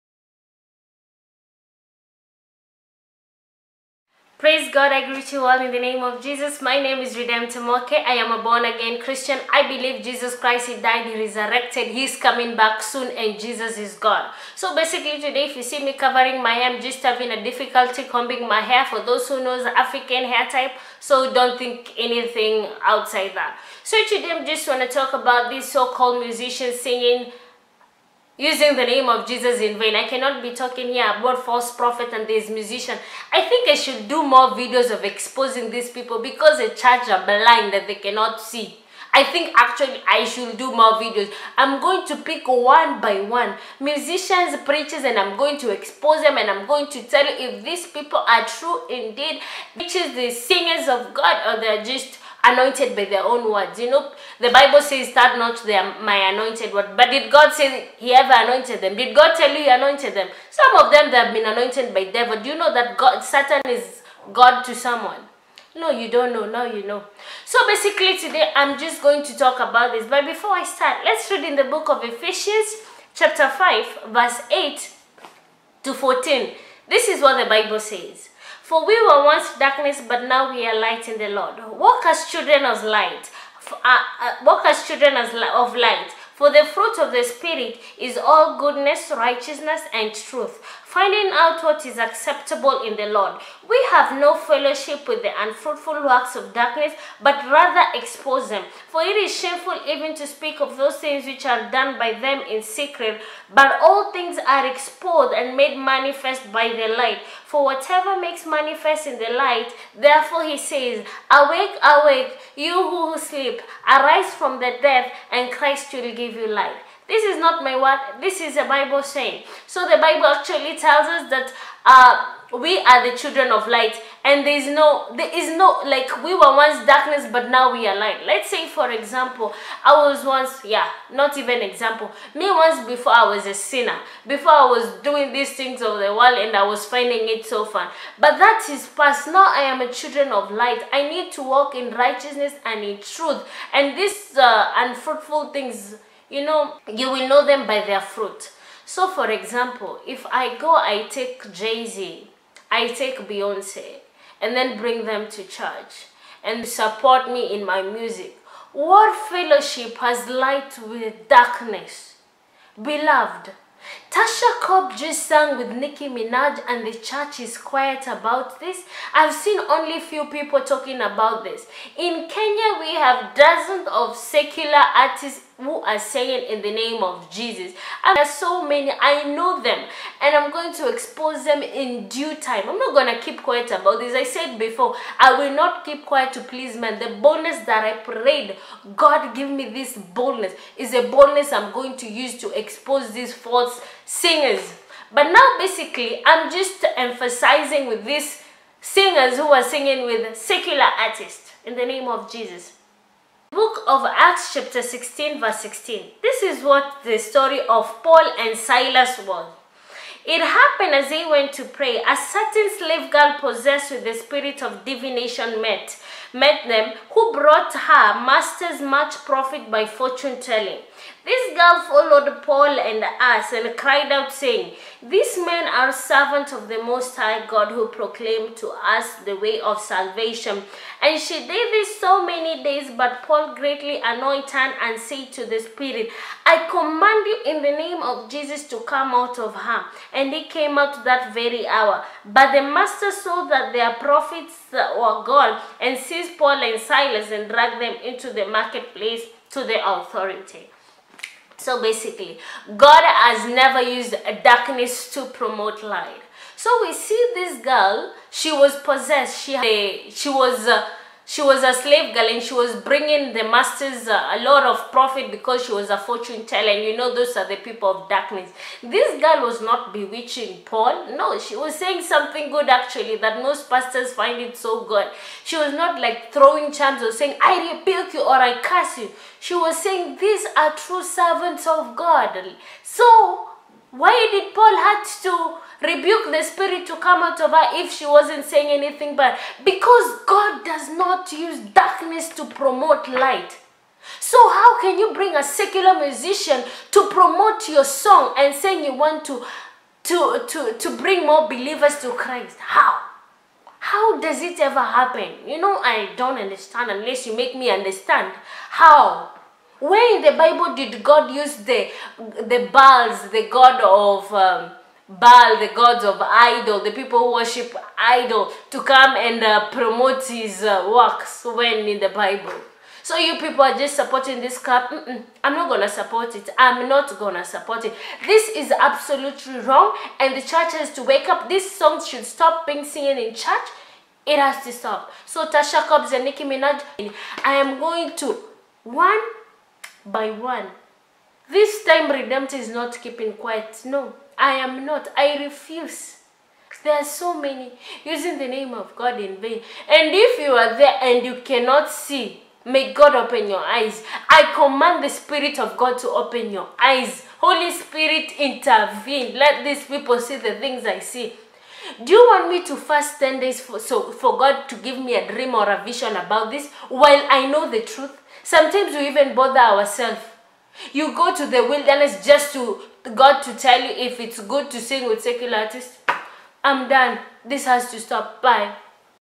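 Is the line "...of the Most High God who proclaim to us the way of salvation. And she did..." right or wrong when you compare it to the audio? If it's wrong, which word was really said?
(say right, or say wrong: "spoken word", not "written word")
right.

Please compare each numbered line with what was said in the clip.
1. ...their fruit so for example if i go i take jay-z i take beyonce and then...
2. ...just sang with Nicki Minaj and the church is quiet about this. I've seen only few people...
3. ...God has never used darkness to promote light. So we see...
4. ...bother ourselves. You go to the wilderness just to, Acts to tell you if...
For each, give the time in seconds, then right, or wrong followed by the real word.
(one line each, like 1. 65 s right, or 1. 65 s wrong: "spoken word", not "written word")
1. 147 s right
2. 164 s right
3. 252 s right
4. 369 s wrong: "God", not "Acts".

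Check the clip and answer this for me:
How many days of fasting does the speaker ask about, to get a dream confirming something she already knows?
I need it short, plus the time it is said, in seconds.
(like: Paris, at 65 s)
10, at 363 s.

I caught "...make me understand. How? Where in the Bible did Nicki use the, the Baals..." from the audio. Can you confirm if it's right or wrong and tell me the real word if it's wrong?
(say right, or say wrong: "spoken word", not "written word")
wrong: "God", not "Nicki".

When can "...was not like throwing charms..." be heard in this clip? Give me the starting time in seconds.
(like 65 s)
275 s.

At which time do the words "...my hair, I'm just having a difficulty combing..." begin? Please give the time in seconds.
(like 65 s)
16 s.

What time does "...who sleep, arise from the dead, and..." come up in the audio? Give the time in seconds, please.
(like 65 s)
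112 s.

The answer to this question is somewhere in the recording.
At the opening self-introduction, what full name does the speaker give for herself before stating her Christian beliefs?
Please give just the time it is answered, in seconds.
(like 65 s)
7 s.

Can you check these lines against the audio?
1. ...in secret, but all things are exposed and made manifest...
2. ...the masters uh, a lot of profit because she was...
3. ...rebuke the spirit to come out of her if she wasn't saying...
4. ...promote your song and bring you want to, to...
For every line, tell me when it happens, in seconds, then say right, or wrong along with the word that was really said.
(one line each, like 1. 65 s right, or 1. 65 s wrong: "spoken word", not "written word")
1. 102 s right
2. 263 s right
3. 285 s right
4. 297 s wrong: "saying", not "bring".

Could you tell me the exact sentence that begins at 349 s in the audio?
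And if you are there and you cannot see, may God open your eyes.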